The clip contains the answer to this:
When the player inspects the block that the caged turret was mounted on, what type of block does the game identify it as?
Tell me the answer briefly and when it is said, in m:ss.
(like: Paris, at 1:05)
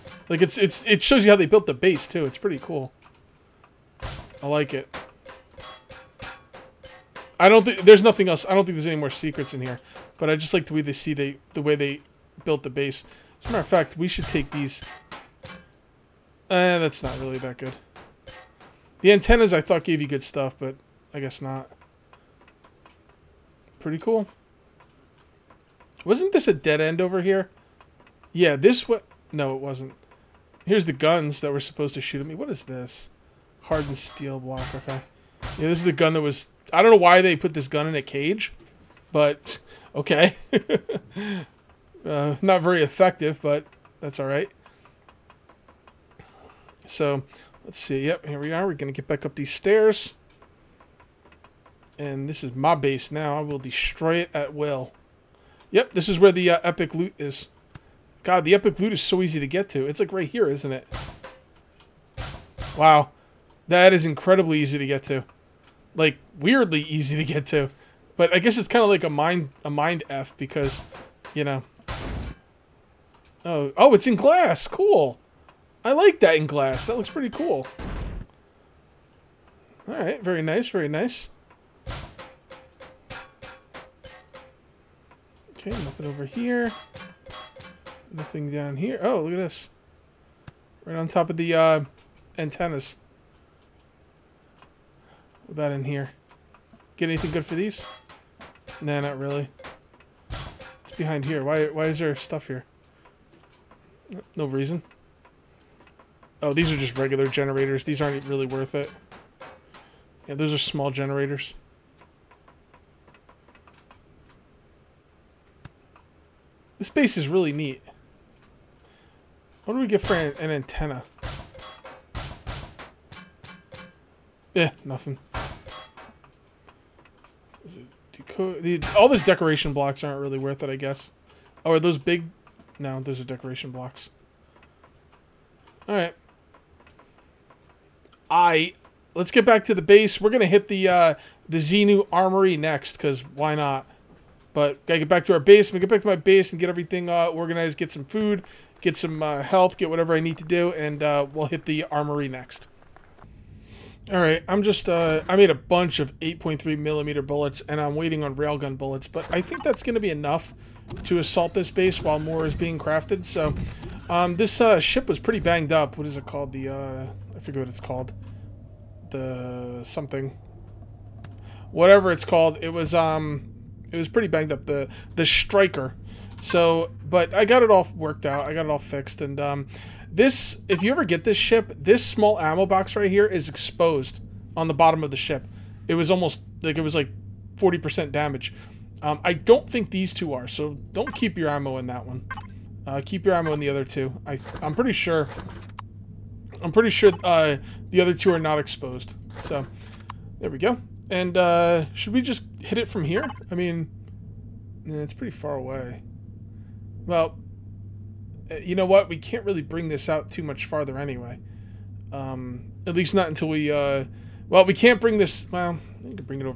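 Hardened steel block, at 0:33.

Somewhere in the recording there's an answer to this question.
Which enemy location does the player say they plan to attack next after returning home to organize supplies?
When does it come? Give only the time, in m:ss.
2:21.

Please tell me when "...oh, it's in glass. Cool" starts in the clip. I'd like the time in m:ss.
1:13.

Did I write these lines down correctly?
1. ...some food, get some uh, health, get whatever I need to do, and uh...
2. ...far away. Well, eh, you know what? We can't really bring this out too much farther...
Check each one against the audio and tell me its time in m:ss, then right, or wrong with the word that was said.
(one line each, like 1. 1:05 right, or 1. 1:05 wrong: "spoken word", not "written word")
1. 2:27 right
2. 3:25 right.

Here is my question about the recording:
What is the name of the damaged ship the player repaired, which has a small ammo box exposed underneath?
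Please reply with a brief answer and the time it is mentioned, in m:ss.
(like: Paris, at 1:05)
The Striker, at 2:55.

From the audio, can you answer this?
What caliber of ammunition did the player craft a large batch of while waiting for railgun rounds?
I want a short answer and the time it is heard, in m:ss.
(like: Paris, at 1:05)
8.3 millimeter, at 2:36.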